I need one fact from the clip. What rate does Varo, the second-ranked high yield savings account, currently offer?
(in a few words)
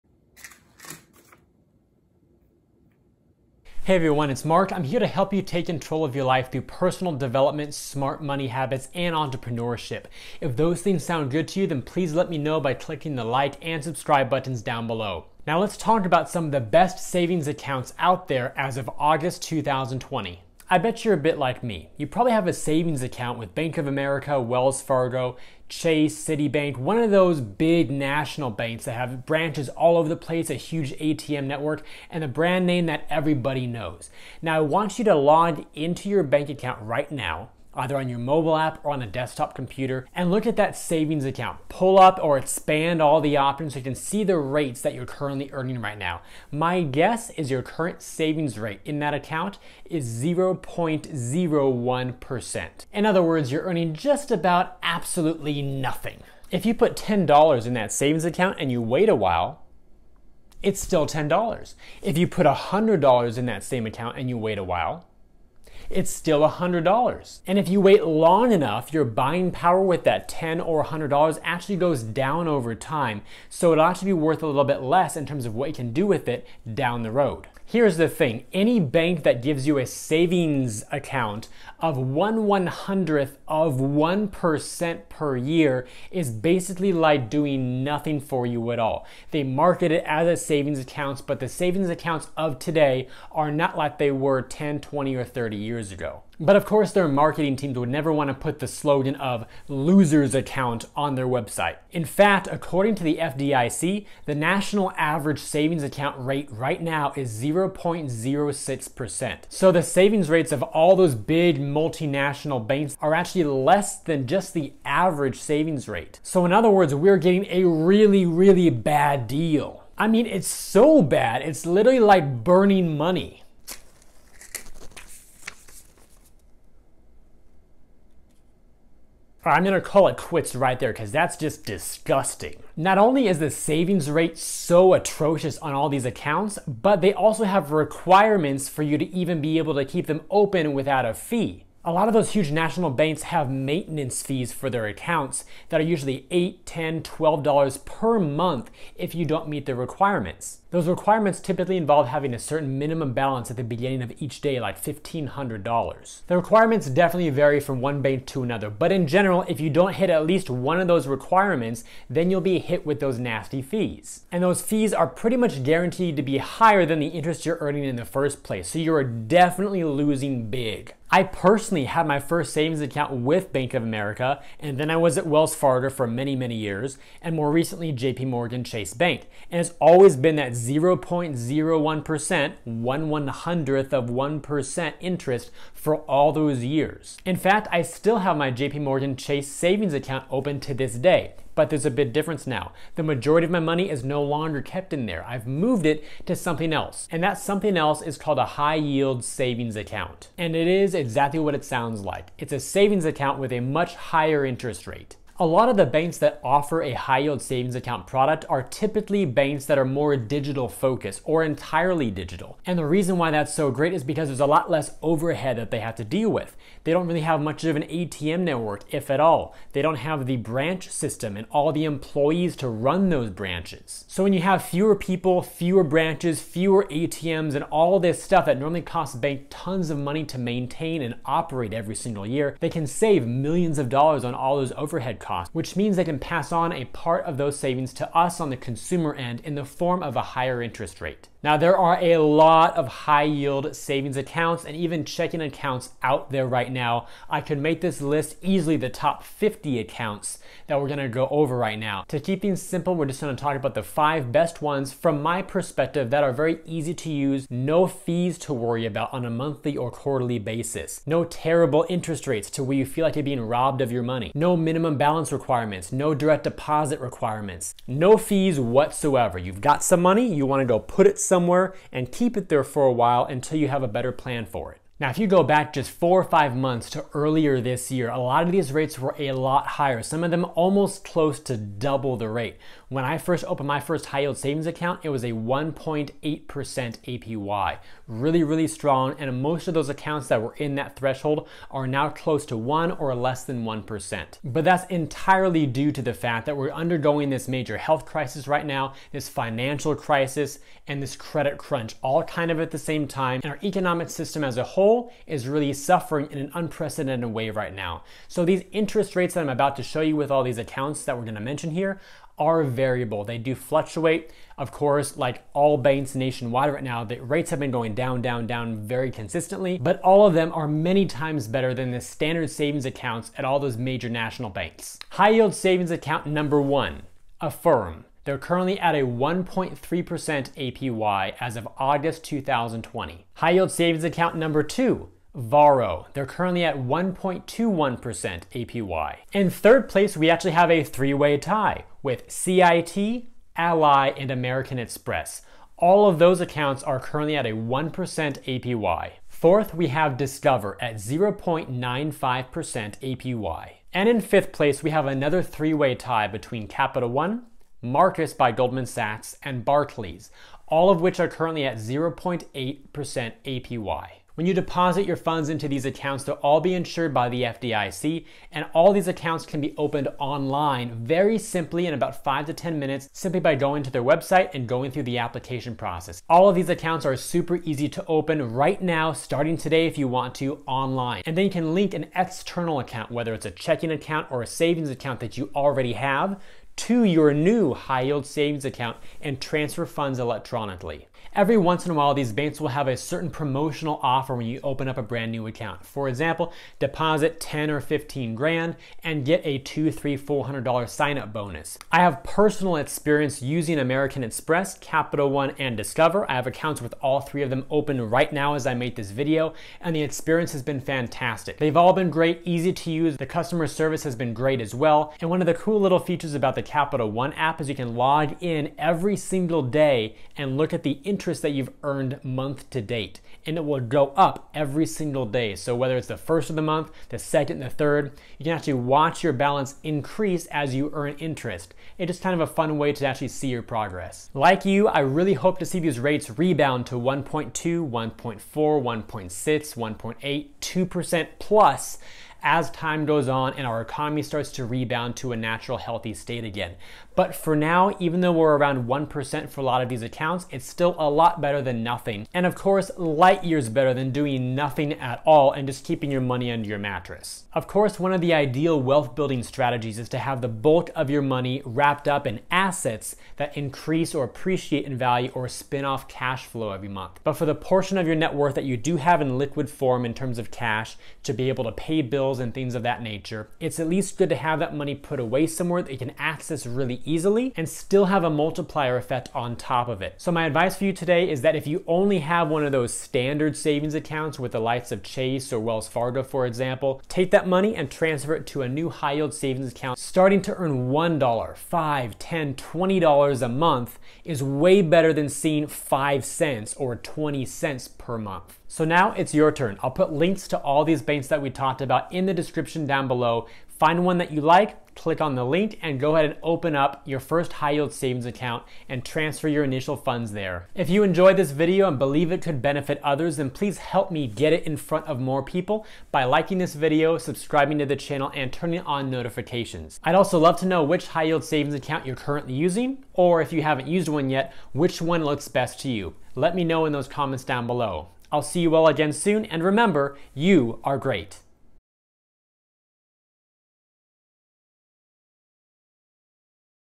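1.21% APY.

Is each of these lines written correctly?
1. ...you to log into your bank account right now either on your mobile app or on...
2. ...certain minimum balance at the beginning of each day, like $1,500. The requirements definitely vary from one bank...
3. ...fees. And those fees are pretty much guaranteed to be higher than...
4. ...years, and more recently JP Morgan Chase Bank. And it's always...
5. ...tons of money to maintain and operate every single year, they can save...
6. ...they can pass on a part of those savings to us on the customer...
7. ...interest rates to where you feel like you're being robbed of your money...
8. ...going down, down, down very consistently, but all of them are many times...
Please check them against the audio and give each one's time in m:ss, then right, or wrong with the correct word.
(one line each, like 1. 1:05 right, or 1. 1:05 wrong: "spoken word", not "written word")
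1. 0:34 right
2. 2:32 right
3. 2:43 right
4. 2:56 right
5. 3:49 right
6. 3:55 wrong: "consumer", not "customer"
7. 4:21 right
8. 5:17 right.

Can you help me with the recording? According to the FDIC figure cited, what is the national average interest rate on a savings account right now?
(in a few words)
0.06%.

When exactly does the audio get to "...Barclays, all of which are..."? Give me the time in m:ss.
5:59.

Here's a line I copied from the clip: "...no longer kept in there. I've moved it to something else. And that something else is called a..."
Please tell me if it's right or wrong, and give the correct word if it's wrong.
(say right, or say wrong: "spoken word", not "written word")
right.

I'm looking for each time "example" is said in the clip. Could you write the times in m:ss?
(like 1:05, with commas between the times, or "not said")
6:36, 8:06.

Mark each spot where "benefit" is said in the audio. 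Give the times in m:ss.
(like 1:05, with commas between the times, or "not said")
8:32.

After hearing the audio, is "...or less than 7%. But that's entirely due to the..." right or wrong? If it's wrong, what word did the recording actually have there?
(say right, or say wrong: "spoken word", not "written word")
wrong: "1", not "7".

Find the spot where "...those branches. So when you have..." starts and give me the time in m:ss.
3:43.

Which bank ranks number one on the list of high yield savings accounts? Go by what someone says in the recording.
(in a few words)
Affirm.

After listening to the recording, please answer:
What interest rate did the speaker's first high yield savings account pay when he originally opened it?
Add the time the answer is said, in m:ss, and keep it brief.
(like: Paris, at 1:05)
1.8% APY, at 4:45.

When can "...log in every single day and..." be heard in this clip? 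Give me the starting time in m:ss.
6:57.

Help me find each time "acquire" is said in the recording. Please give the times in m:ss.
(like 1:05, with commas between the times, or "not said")
not said.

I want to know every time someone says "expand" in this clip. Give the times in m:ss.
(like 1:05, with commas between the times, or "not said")
0:42.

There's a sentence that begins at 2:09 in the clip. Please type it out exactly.
I'm gonna call it quits right there because that's just disgusting.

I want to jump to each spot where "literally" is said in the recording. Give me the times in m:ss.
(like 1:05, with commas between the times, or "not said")
2:01.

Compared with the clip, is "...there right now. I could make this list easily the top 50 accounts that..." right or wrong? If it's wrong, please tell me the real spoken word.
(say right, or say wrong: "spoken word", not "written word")
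right.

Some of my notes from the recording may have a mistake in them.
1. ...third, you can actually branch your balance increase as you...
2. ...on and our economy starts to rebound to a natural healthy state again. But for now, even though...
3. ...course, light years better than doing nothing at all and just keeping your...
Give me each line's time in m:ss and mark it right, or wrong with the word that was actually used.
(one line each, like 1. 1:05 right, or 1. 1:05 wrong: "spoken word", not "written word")
1. 7:07 wrong: "watch", not "branch"
2. 7:23 right
3. 7:32 right.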